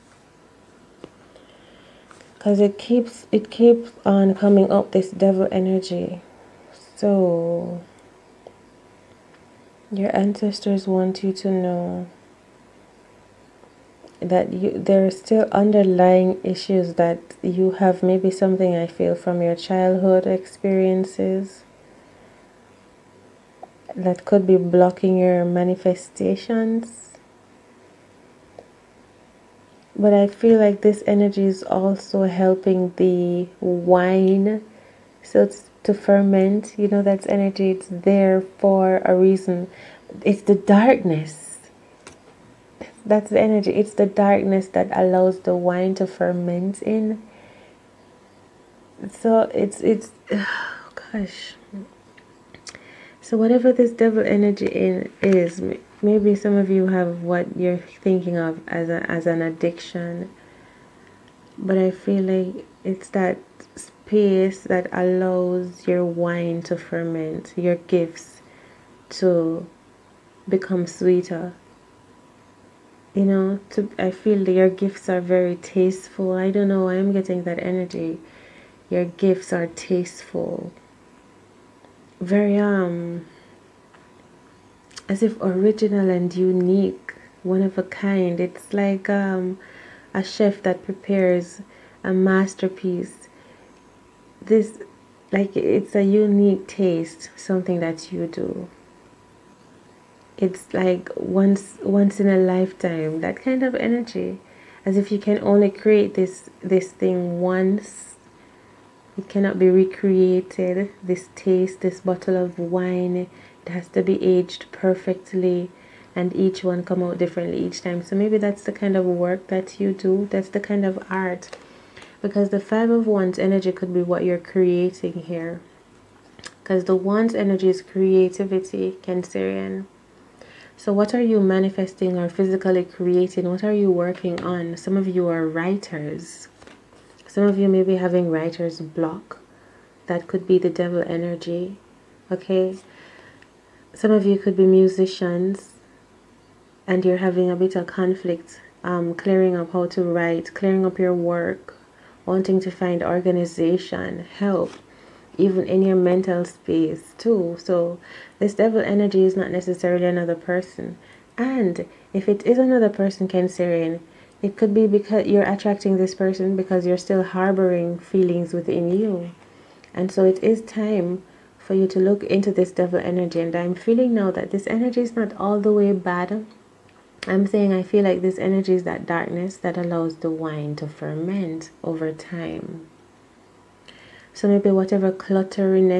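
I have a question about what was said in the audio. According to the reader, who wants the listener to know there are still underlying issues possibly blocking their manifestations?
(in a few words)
ancestors.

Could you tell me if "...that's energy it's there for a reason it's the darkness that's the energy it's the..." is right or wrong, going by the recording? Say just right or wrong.
right.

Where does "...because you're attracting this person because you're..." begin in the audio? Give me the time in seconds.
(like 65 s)
164 s.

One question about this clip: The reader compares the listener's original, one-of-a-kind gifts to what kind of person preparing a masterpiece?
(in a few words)
chef.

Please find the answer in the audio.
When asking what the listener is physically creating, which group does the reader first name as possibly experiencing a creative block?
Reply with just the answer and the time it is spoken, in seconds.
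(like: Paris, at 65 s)
writers, at 135 s.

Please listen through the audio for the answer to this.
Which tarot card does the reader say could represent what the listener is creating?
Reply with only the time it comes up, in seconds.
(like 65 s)
122 s.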